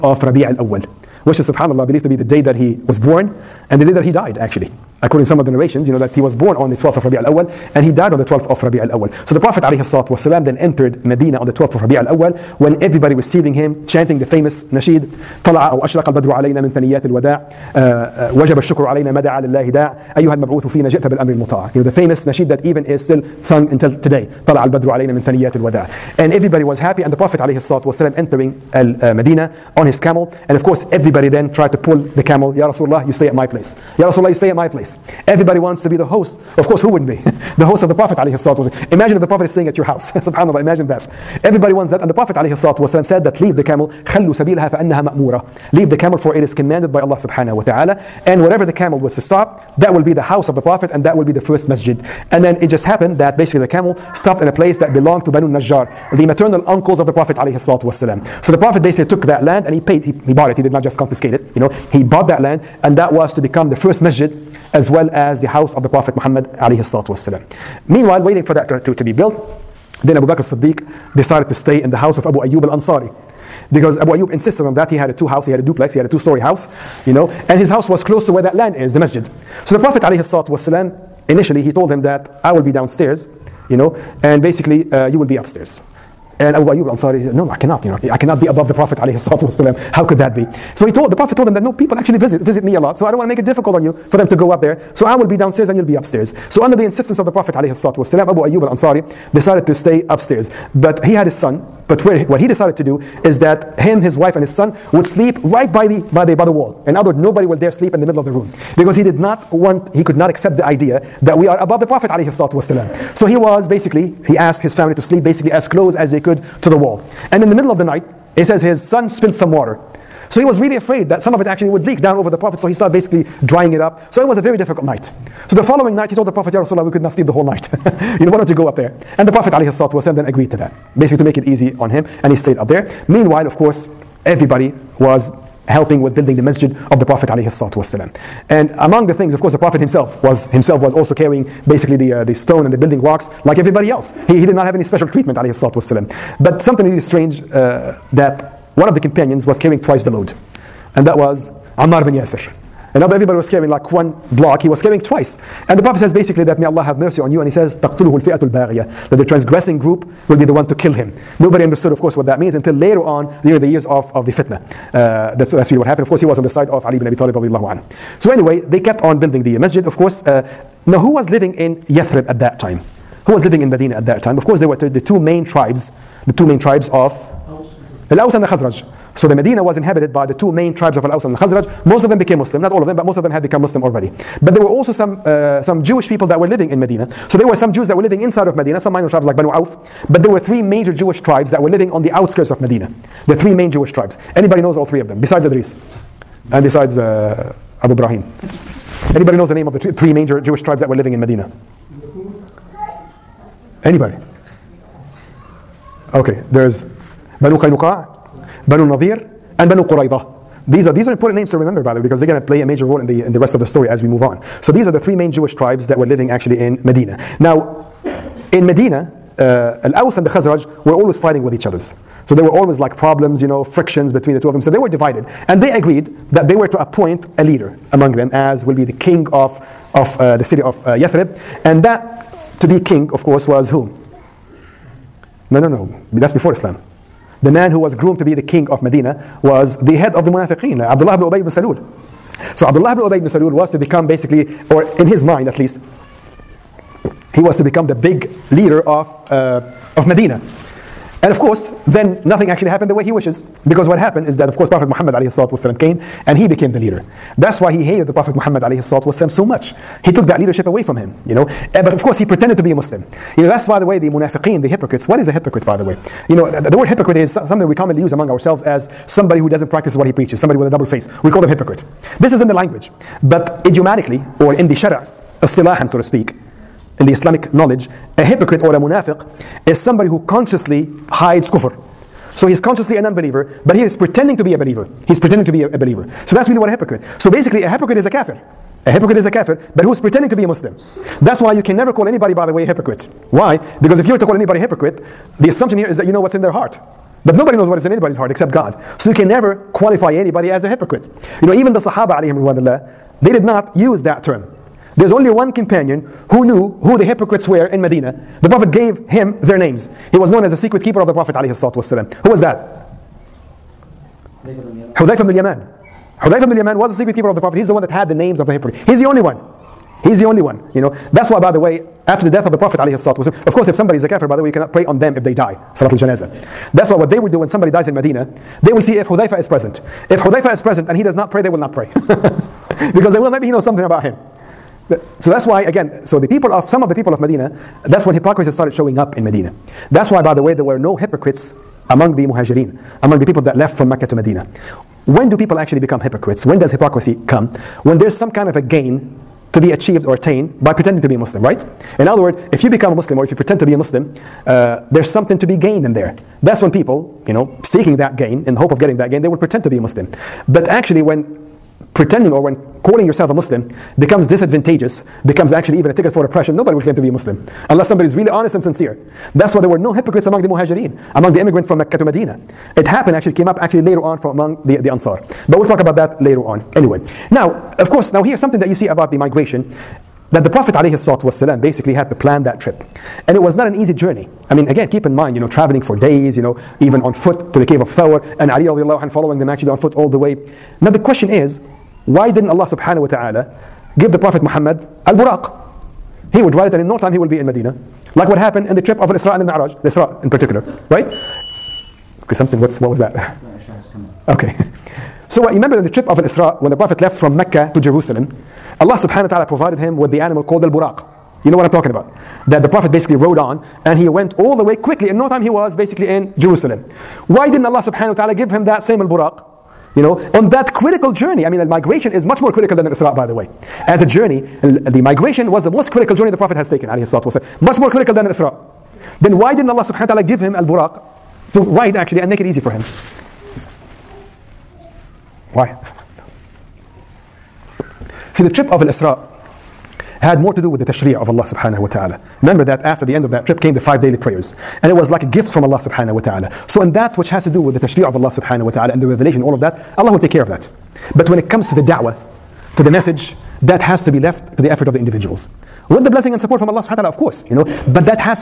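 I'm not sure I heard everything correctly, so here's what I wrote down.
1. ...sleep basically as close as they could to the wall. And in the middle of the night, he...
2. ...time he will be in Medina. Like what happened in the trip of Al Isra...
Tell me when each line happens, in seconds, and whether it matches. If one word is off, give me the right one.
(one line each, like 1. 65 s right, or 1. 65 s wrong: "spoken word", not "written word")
1. 115 s right
2. 396 s right.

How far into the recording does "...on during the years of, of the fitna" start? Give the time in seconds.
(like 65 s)
163 s.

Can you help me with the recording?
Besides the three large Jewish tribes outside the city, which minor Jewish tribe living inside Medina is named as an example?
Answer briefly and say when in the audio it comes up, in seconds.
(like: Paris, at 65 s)
Banu Auf, at 189 s.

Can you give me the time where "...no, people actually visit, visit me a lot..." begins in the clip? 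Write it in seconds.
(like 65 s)
91 s.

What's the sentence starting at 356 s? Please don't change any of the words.
That's when people, you know, seeking that gain in hope of getting that gain, they will pretend to be a Muslim.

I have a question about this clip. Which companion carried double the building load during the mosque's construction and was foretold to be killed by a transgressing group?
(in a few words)
Ammar bin Yasir.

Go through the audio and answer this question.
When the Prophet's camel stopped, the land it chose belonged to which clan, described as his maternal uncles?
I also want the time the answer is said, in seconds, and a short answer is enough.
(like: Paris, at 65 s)
Banu Najjar, at 55 s.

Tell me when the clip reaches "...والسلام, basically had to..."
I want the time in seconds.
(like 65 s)
380 s.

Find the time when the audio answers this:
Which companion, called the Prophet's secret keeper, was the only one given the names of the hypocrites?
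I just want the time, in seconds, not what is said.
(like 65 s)
316 s.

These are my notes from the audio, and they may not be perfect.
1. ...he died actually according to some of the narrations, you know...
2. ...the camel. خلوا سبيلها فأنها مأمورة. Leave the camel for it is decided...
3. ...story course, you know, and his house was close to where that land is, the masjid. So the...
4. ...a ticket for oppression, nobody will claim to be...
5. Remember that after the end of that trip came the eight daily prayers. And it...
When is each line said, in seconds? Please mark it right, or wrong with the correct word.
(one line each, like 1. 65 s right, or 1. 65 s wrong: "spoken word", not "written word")
1. 4 s right
2. 43 s wrong: "commanded", not "decided"
3. 76 s wrong: "house", not "course"
4. 365 s right
5. 442 s wrong: "five", not "eight".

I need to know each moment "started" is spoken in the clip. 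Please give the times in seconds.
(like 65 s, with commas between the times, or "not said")
122 s, 338 s.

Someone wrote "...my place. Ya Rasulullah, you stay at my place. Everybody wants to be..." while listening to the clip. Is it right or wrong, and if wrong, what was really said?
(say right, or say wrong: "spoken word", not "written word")
right.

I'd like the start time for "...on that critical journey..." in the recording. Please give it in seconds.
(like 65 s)
420 s.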